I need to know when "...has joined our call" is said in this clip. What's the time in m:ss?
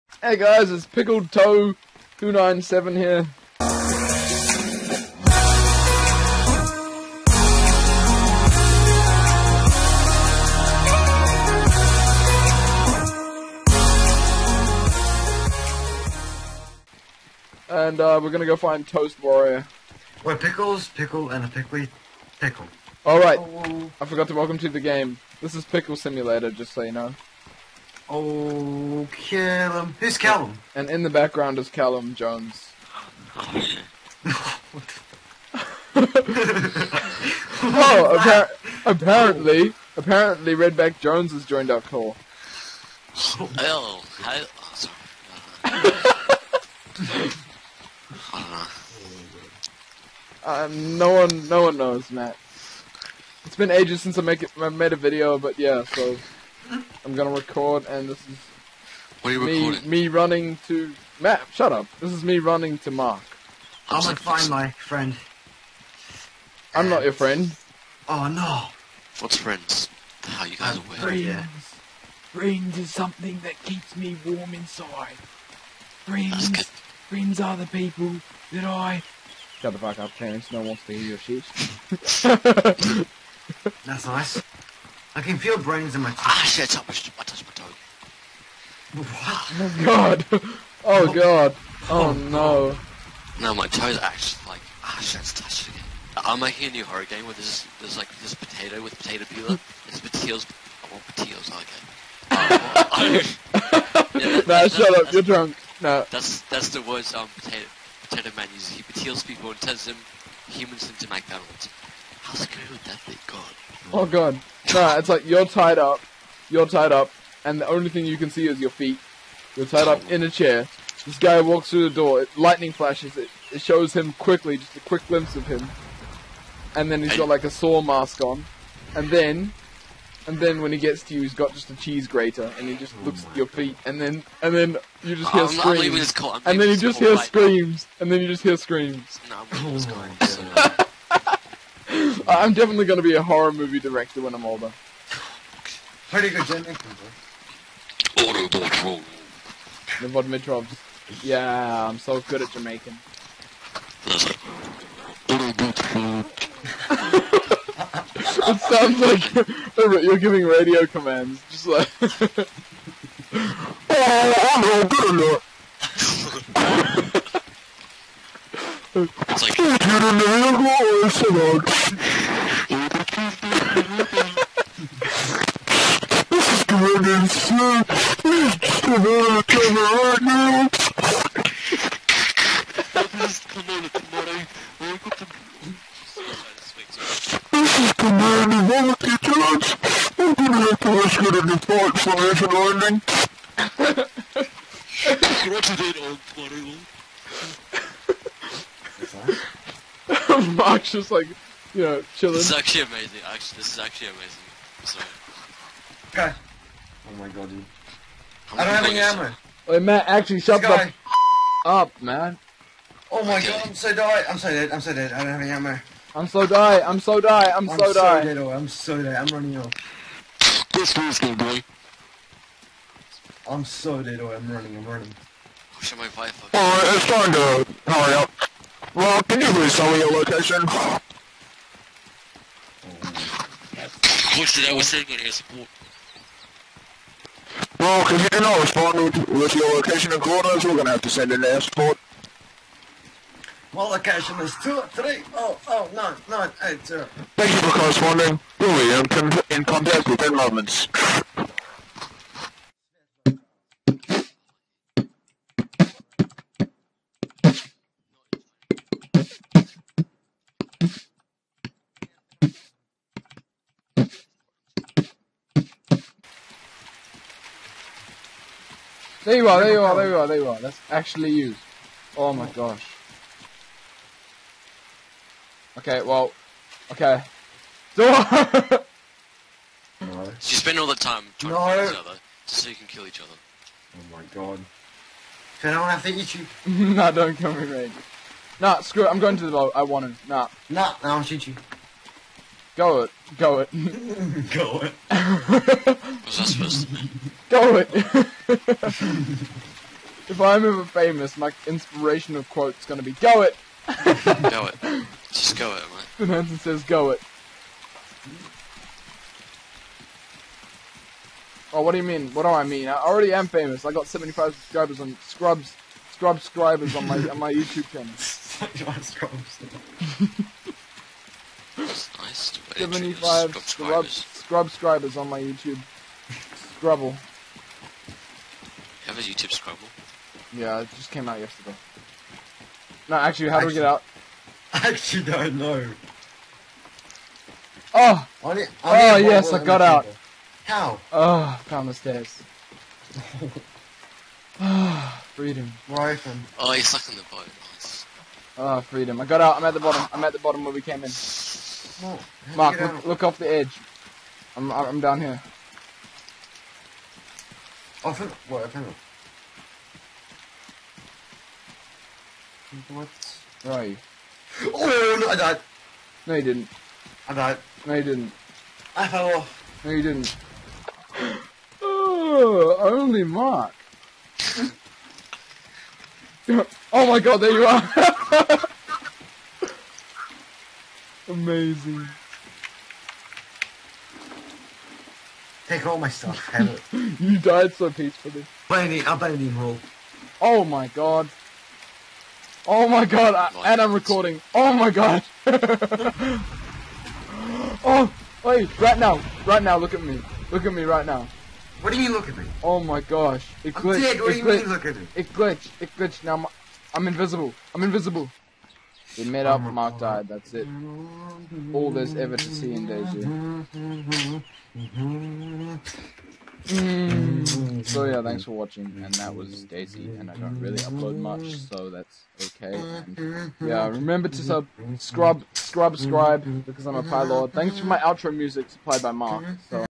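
0:41.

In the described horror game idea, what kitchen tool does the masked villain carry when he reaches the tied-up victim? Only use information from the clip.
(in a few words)
cheese grater.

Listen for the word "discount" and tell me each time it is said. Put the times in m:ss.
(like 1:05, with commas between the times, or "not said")
not said.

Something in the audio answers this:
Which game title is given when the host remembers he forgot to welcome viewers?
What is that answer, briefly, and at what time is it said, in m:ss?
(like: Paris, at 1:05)
Pickle Simulator, at 0:25.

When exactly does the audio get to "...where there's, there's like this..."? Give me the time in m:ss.
1:37.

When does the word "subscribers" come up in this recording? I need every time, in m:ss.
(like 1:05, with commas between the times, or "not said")
5:14, 5:24.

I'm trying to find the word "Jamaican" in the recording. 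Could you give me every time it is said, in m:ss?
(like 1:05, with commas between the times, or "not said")
2:26, 2:32.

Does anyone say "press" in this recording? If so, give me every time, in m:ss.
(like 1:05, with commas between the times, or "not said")
not said.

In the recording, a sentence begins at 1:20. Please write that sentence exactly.
No one wants to hear your shit.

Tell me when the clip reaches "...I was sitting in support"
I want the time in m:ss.
3:54.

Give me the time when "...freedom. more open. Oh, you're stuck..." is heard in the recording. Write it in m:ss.
5:45.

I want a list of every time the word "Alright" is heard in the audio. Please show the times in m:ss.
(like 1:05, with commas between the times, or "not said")
0:23, 3:46.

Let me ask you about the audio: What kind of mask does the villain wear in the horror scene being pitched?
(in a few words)
saw mask.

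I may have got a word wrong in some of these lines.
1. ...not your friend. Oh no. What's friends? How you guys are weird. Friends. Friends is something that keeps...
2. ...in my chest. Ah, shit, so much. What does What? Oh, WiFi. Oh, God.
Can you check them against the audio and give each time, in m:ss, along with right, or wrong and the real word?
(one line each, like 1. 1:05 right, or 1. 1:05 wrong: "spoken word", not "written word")
1. 1:06 right
2. 1:25 wrong: "God", not "WiFi".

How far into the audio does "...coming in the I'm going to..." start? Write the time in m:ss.
3:07.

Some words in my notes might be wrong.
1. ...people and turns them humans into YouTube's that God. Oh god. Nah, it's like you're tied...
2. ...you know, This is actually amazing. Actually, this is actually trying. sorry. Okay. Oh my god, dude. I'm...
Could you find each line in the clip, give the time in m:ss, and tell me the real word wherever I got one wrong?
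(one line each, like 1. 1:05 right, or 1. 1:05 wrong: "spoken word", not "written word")
1. 1:49 wrong: "McDonald", not "YouTube"
2. 3:21 wrong: "amazing", not "trying".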